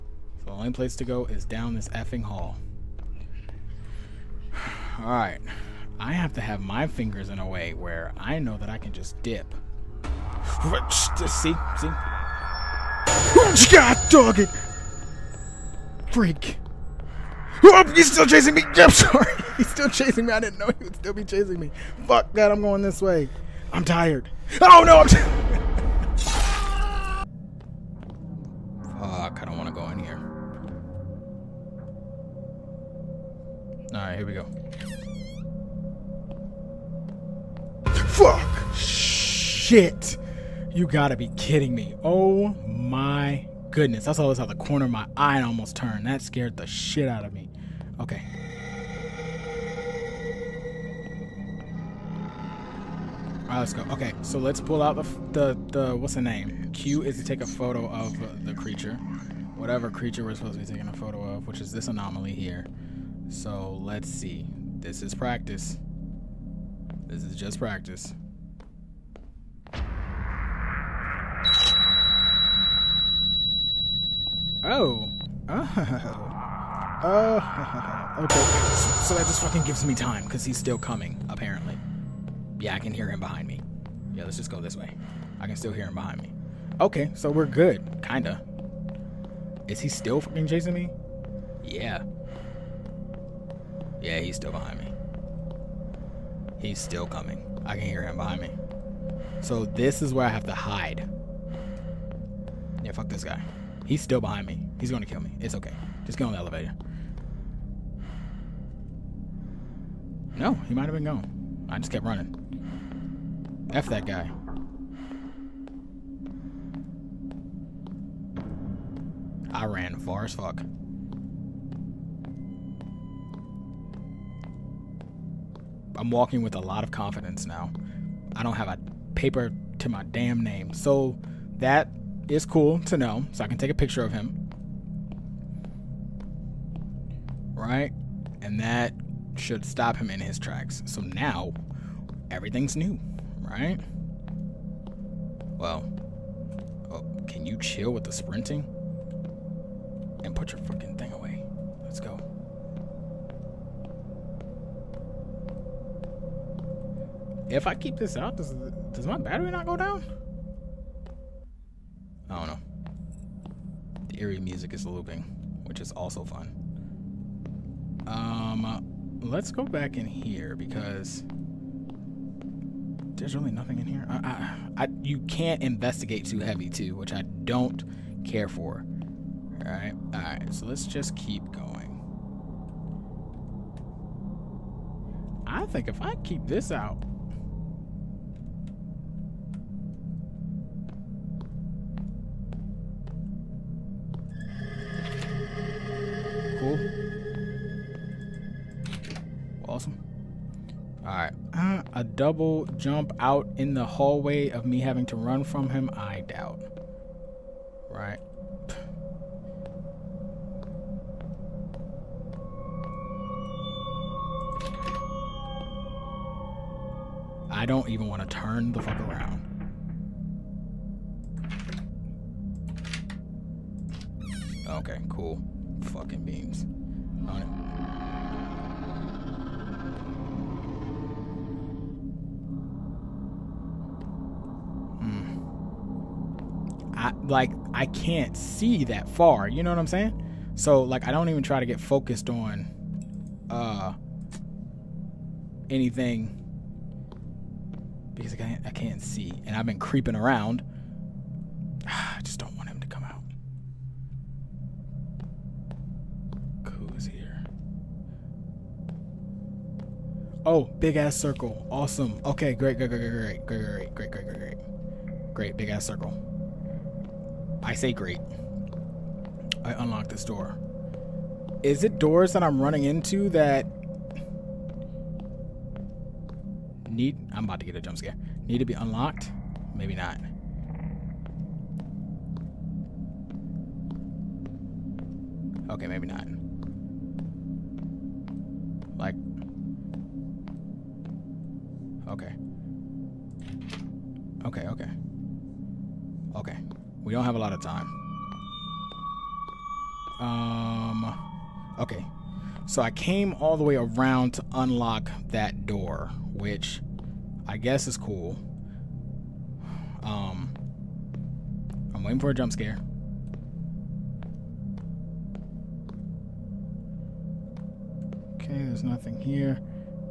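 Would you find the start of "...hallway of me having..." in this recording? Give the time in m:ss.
3:23.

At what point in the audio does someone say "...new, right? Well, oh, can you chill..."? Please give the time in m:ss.
2:22.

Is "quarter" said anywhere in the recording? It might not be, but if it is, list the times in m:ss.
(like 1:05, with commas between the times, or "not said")
not said.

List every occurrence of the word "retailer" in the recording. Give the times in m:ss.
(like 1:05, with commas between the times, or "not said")
not said.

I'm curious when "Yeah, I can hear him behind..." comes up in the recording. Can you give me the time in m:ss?
1:22.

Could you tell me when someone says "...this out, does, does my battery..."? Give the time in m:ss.
2:37.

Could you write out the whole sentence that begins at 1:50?
No, he might have been gone.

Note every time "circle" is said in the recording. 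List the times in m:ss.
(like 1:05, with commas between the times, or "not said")
4:21, 4:25.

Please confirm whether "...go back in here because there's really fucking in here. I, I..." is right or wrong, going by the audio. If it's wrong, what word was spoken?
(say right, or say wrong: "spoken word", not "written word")
wrong: "nothing", not "fucking".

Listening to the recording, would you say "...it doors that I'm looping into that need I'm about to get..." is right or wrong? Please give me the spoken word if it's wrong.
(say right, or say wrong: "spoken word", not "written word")
wrong: "running", not "looping".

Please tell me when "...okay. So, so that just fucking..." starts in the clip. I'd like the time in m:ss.
1:18.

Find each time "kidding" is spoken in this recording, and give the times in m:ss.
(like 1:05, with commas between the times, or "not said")
0:41.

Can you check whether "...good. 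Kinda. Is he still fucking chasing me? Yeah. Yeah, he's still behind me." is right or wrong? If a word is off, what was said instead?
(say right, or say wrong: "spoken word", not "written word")
right.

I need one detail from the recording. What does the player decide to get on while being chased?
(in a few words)
The elevator.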